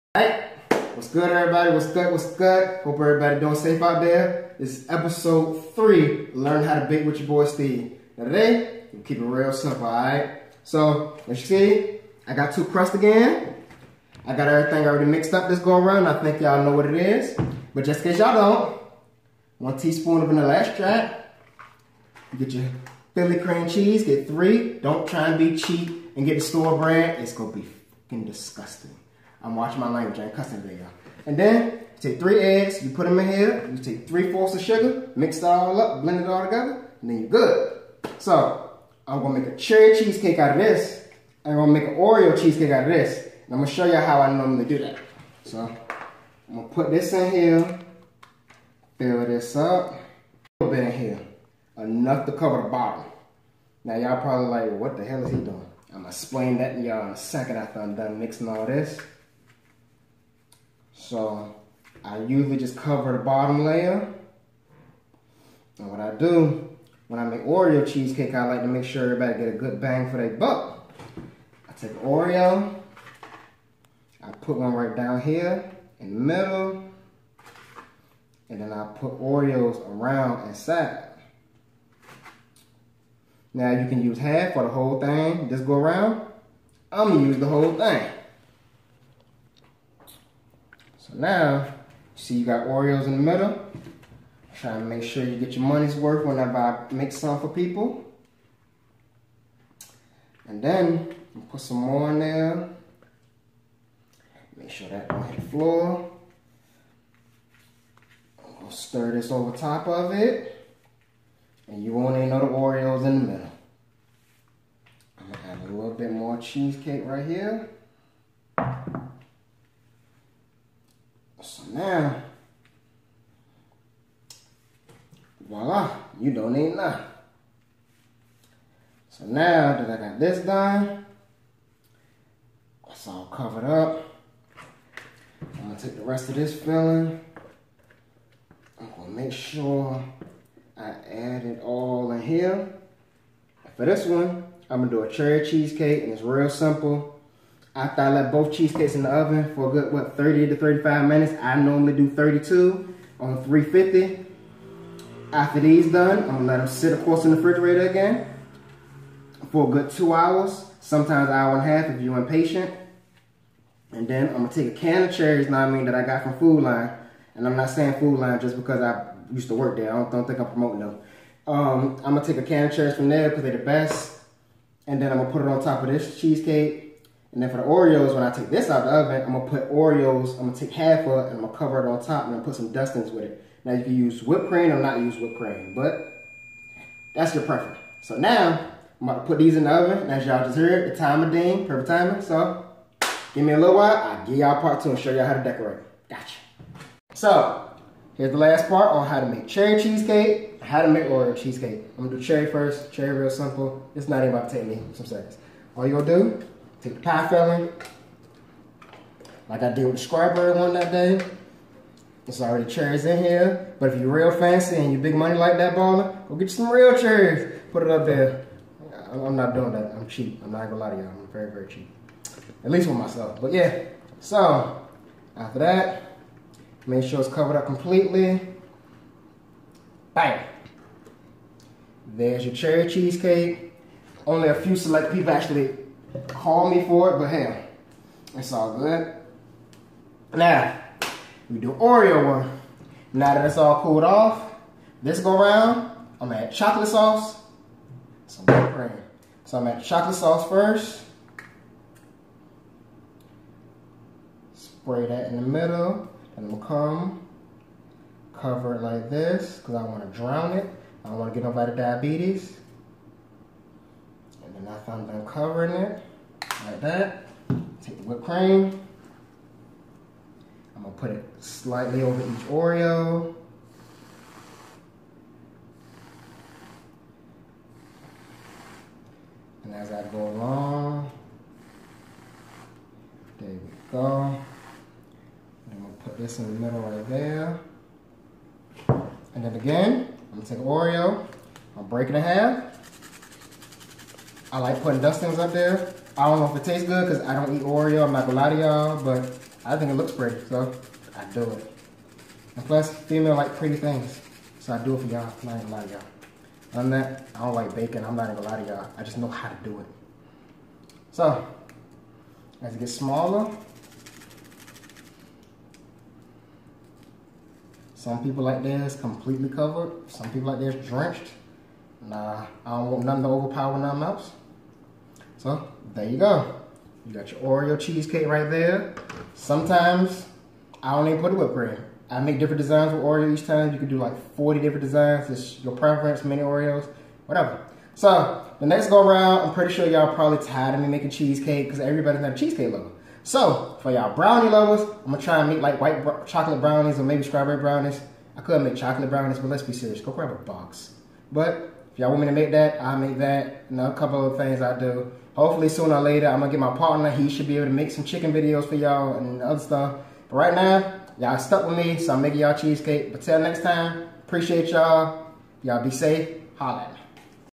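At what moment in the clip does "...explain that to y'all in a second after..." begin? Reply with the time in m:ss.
0:56.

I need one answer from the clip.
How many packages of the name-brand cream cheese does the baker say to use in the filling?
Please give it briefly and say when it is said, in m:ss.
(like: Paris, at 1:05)
3, at 0:24.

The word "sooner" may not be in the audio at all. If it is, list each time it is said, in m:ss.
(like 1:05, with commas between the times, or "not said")
5:55.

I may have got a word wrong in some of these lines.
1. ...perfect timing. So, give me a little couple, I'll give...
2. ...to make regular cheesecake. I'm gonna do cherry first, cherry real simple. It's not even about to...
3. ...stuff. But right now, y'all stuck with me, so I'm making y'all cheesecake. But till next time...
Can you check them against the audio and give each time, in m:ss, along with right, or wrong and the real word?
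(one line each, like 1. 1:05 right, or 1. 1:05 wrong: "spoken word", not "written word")
1. 3:11 wrong: "while", not "couple"
2. 3:20 right
3. 5:59 right.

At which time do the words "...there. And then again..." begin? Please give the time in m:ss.
4:47.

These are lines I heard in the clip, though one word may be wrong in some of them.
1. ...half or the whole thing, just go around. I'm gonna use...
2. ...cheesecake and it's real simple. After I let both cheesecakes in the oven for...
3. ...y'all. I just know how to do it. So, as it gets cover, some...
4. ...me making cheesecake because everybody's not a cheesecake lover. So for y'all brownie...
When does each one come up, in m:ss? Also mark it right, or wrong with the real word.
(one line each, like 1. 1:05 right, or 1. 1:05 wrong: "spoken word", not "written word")
1. 1:24 right
2. 2:25 right
3. 5:08 wrong: "smaller", not "cover"
4. 5:40 right.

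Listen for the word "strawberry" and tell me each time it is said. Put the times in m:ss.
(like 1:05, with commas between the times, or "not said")
3:30, 5:47.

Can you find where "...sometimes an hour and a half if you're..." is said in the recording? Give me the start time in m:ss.
2:40.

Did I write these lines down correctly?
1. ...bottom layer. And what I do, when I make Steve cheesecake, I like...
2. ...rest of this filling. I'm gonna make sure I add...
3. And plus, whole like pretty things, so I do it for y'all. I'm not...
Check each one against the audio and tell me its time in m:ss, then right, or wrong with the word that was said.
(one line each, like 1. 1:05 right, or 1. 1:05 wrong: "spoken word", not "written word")
1. 1:03 wrong: "Oreo", not "Steve"
2. 2:16 right
3. 5:02 wrong: "female", not "whole".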